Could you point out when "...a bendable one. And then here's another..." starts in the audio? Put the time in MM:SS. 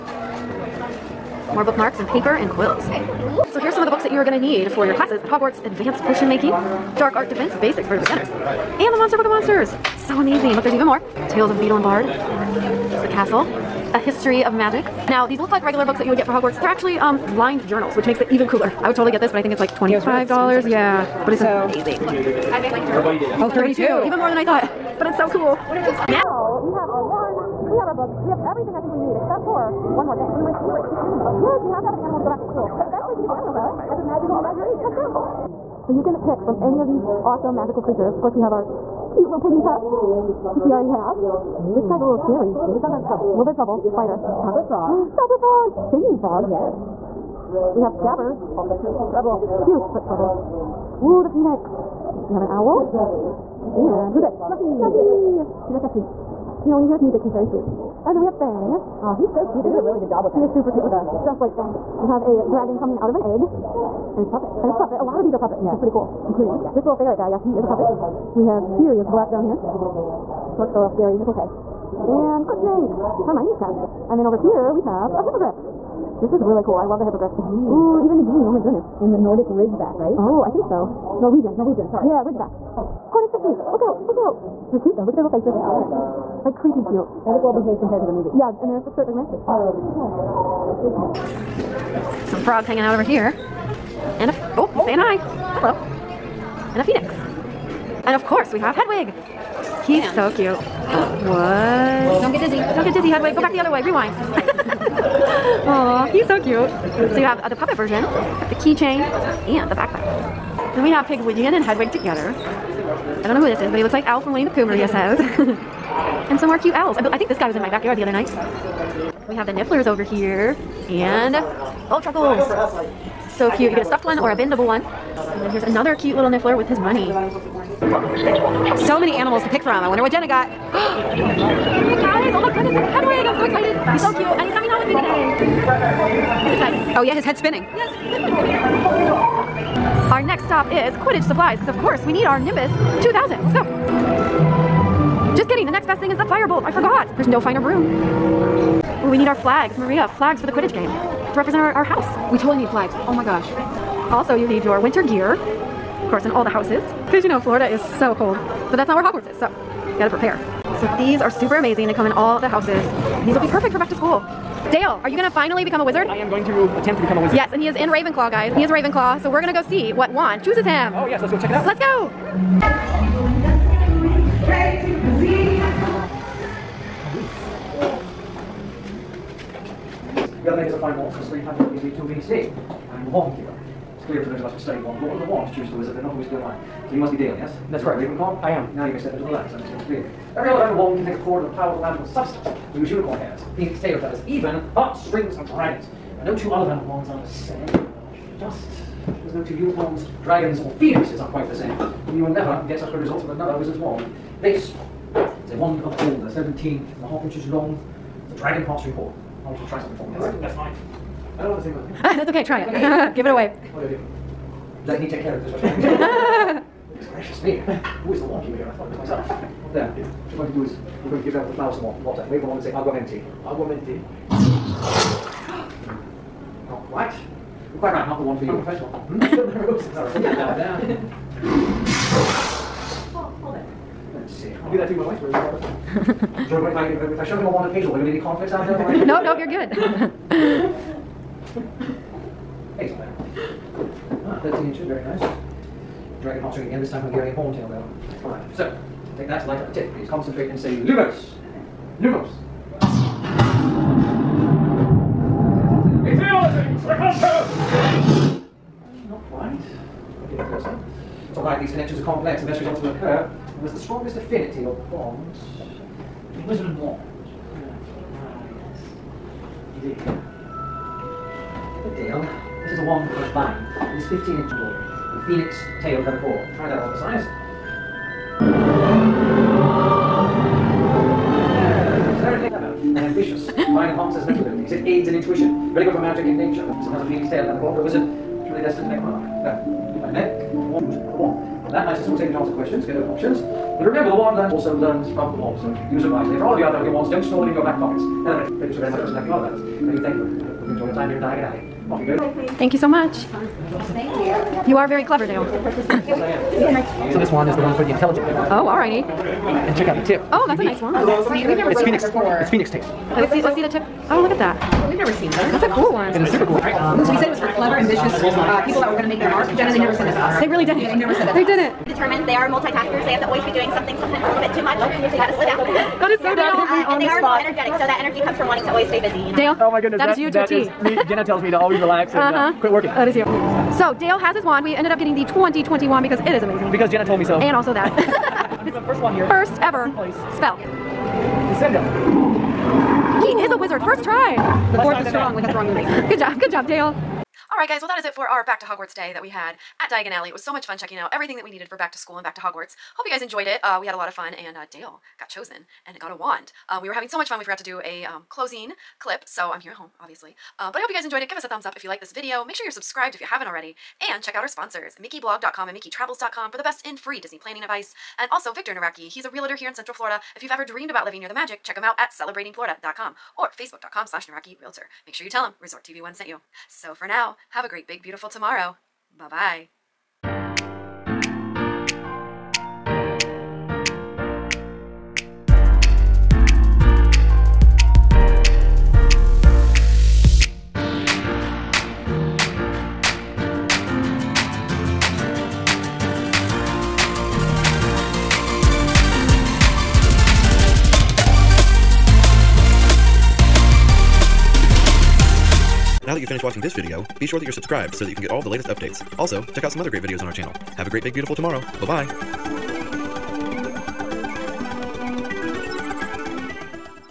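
02:04.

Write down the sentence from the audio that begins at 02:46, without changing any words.
I am going to attempt to become a wizard.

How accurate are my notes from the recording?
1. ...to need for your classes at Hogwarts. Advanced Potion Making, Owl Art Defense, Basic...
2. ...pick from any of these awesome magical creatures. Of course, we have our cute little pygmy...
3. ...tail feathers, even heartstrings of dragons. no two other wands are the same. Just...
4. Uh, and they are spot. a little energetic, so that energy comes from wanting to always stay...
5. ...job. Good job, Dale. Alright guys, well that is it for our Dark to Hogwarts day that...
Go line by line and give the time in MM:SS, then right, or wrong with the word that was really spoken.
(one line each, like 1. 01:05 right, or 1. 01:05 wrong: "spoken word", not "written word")
1. 00:04 wrong: "Dark", not "Owl"
2. 00:36 right
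3. 03:13 right
4. 05:26 right
5. 05:46 wrong: "Back", not "Dark".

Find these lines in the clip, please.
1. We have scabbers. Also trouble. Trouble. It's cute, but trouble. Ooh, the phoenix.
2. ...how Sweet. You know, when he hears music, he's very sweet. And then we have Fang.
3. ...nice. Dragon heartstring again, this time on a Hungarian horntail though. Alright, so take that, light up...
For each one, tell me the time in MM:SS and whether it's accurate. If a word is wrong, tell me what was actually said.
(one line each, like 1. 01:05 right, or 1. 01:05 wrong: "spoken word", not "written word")
1. 00:47 right
2. 00:55 right
3. 04:05 right.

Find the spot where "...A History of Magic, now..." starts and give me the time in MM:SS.
00:13.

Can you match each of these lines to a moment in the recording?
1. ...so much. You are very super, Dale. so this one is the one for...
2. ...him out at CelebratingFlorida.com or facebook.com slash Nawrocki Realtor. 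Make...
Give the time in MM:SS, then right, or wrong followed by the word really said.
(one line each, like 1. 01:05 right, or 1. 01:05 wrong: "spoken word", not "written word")
1. 05:02 wrong: "clever", not "super"
2. 06:11 right.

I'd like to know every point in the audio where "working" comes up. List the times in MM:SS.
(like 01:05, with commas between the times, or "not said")
05:32.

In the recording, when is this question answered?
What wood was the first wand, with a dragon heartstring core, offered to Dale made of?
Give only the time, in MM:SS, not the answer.
03:25.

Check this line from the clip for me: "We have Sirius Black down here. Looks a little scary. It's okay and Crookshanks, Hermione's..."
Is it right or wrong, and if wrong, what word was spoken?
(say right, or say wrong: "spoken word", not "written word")
right.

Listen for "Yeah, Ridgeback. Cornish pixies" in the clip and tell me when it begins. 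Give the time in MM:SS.
01:22.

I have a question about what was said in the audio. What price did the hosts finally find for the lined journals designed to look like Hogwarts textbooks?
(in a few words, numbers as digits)
$32.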